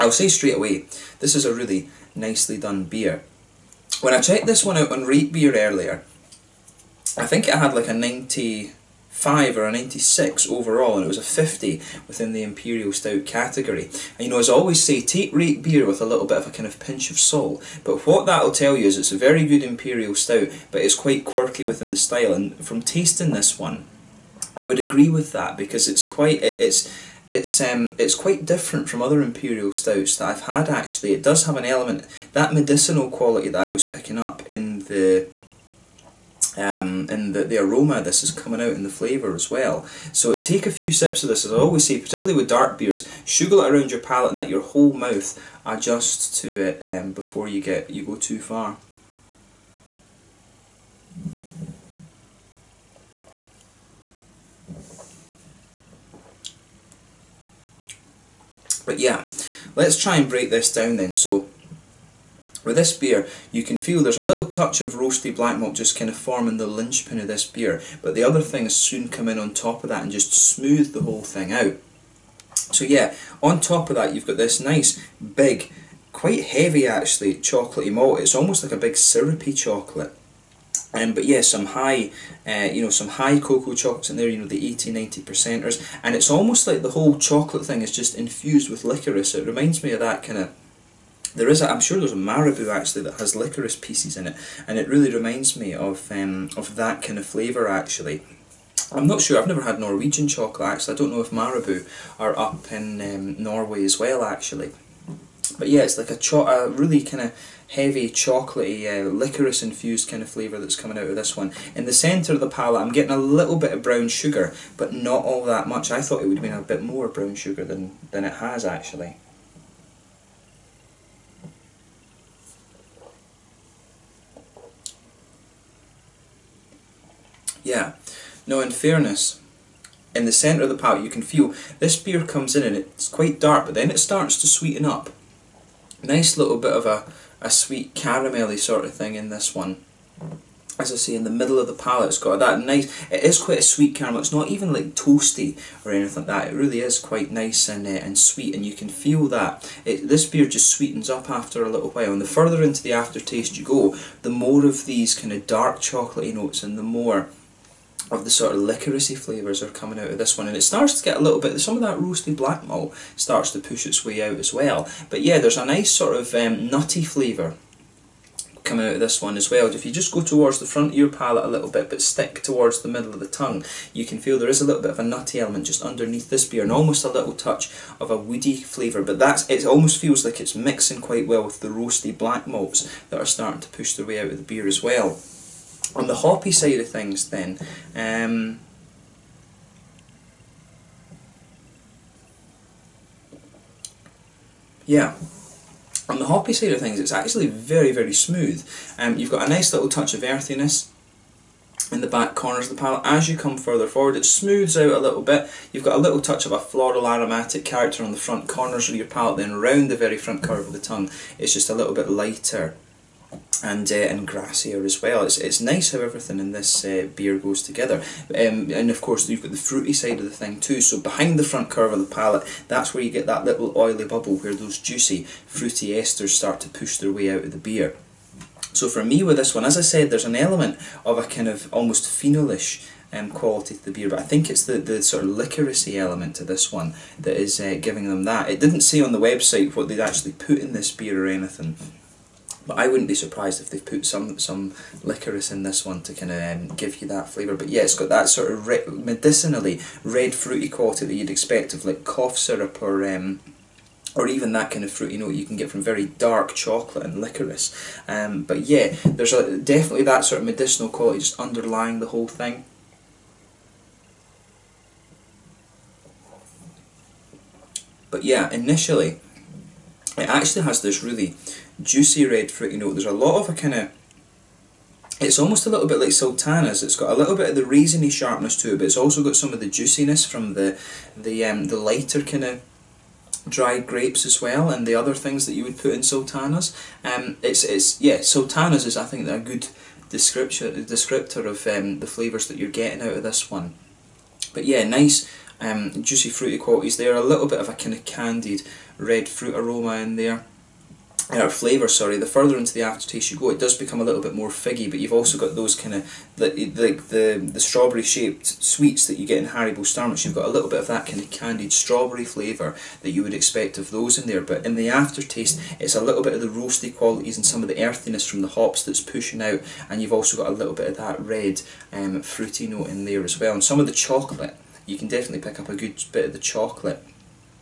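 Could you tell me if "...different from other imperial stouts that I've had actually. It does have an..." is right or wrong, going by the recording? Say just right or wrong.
right.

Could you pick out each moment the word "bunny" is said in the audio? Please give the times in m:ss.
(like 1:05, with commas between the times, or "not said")
not said.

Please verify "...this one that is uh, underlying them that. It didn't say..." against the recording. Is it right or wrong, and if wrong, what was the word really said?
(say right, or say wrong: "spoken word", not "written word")
wrong: "giving", not "underlying".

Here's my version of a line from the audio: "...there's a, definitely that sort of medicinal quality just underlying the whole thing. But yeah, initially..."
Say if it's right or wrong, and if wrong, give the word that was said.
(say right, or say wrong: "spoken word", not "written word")
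right.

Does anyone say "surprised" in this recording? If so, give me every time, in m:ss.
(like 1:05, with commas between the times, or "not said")
4:03.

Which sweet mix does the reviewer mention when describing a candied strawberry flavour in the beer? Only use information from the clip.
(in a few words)
Haribo Starmix.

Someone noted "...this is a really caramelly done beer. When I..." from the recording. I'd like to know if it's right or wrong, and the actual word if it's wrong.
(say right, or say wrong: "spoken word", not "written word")
wrong: "nicely", not "caramelly".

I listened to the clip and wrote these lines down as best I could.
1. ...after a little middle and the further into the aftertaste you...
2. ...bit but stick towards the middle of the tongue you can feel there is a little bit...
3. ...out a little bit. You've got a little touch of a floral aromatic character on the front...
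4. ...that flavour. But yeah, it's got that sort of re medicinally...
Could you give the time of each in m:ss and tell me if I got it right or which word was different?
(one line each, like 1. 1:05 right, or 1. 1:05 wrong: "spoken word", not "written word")
1. 2:31 wrong: "while", not "middle"
2. 2:51 right
3. 3:24 right
4. 4:07 right.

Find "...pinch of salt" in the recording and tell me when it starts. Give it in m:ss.
0:16.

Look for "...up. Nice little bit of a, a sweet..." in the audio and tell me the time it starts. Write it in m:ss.
2:14.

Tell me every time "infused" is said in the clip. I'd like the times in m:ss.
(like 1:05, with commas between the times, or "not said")
1:28, 1:49.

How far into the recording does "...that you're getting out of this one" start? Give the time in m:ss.
4:52.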